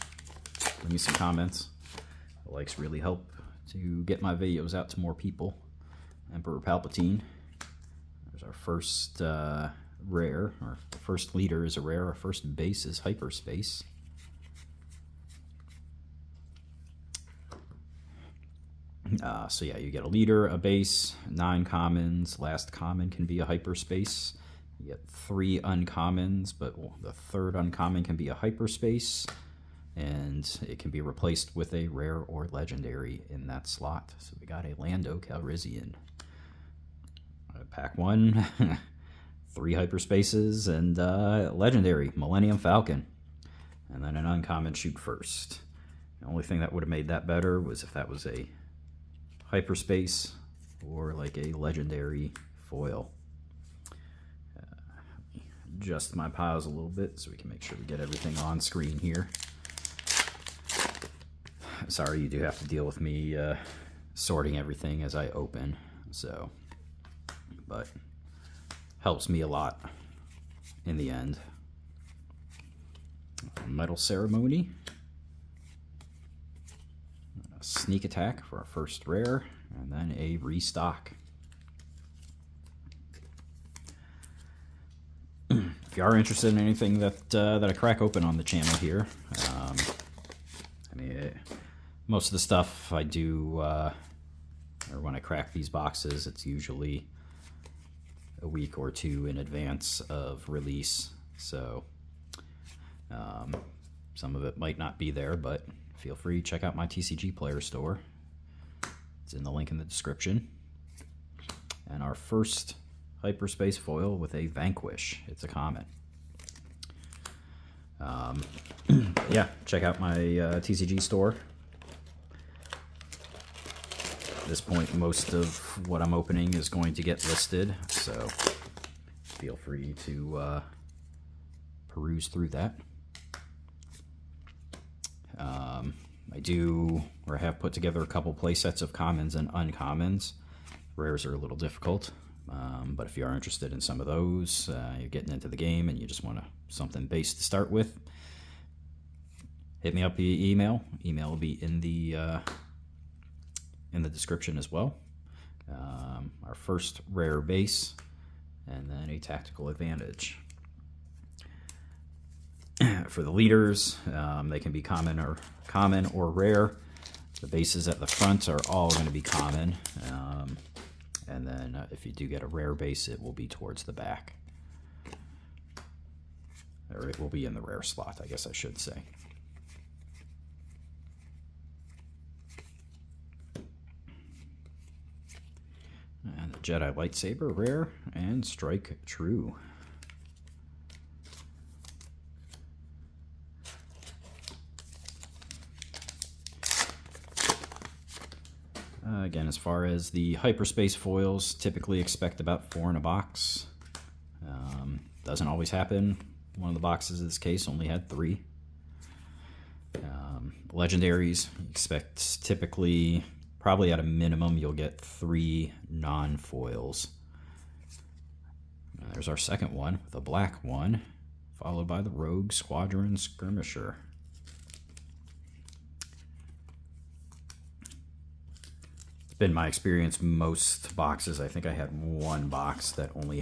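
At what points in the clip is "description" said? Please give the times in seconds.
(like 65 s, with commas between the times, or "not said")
109 s, 154 s.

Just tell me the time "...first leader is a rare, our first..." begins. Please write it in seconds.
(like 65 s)
11 s.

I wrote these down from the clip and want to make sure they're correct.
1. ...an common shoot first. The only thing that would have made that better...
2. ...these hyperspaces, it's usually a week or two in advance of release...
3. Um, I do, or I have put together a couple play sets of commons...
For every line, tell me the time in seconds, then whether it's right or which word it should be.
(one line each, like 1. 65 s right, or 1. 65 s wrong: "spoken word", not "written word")
1. 44 s wrong: "uncommon", not "common"
2. 95 s wrong: "boxes", not "hyperspaces"
3. 135 s right.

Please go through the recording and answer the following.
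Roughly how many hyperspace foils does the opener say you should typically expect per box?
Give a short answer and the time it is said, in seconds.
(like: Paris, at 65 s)
4, at 202 s.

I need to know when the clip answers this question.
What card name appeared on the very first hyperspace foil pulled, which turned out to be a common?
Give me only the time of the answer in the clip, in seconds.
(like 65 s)
114 s.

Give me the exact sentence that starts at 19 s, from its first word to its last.
Uh, so yeah, you get a leader, a base, nine commons.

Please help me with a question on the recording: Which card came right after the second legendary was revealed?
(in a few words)
Rogue Squadron Skirmisher.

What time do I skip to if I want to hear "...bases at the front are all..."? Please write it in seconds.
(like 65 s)
167 s.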